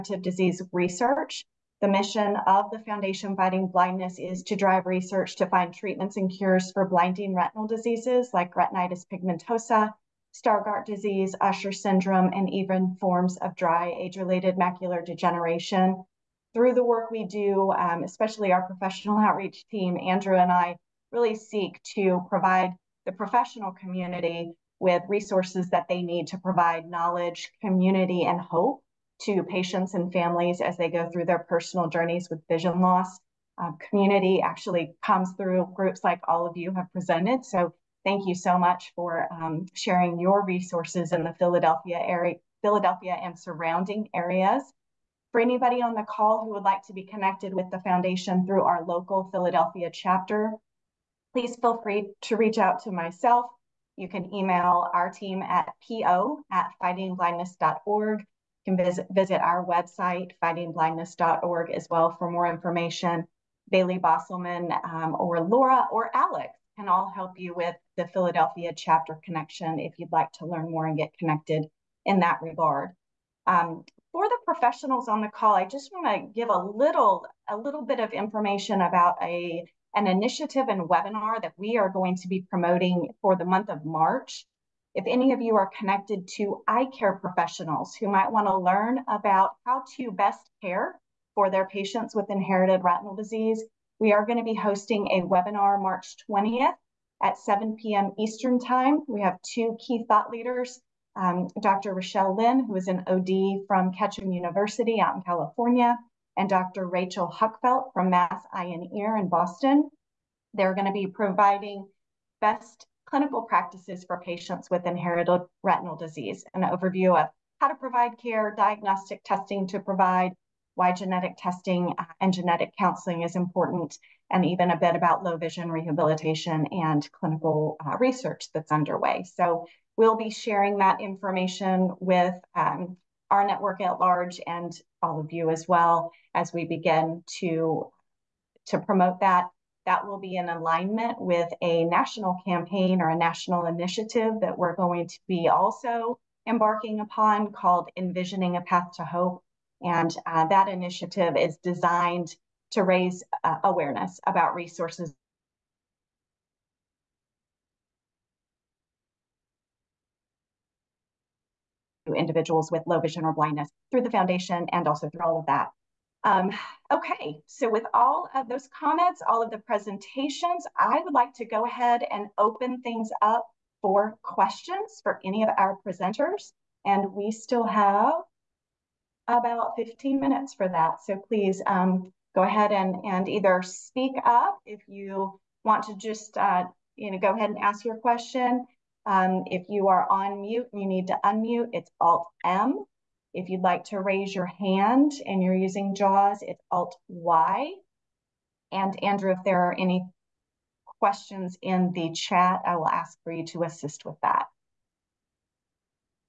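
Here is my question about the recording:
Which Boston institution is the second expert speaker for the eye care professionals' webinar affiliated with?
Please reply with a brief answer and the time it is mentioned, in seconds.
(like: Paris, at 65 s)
Mass Eye and Ear, at 108 s.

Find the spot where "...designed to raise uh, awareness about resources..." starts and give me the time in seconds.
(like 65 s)
151 s.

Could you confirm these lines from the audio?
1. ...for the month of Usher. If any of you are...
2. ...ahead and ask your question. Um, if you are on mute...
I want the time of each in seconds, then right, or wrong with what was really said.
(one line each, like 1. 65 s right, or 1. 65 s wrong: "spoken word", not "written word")
1. 83 s wrong: "March", not "Usher"
2. 187 s right.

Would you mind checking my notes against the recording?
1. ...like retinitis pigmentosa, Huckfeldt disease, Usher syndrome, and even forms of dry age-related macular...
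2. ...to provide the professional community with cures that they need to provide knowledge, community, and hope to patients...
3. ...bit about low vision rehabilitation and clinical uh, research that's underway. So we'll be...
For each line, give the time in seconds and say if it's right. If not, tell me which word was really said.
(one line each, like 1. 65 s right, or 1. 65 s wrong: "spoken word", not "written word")
1. 8 s wrong: "Stargardt", not "Huckfeldt"
2. 21 s wrong: "resources", not "cures"
3. 124 s right.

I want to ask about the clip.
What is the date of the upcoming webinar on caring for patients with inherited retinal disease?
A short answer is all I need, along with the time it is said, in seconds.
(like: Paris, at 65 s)
March 20th, at 95 s.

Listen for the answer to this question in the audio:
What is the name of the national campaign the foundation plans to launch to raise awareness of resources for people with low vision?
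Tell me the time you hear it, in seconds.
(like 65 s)
147 s.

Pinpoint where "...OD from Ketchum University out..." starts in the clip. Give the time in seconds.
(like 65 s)
103 s.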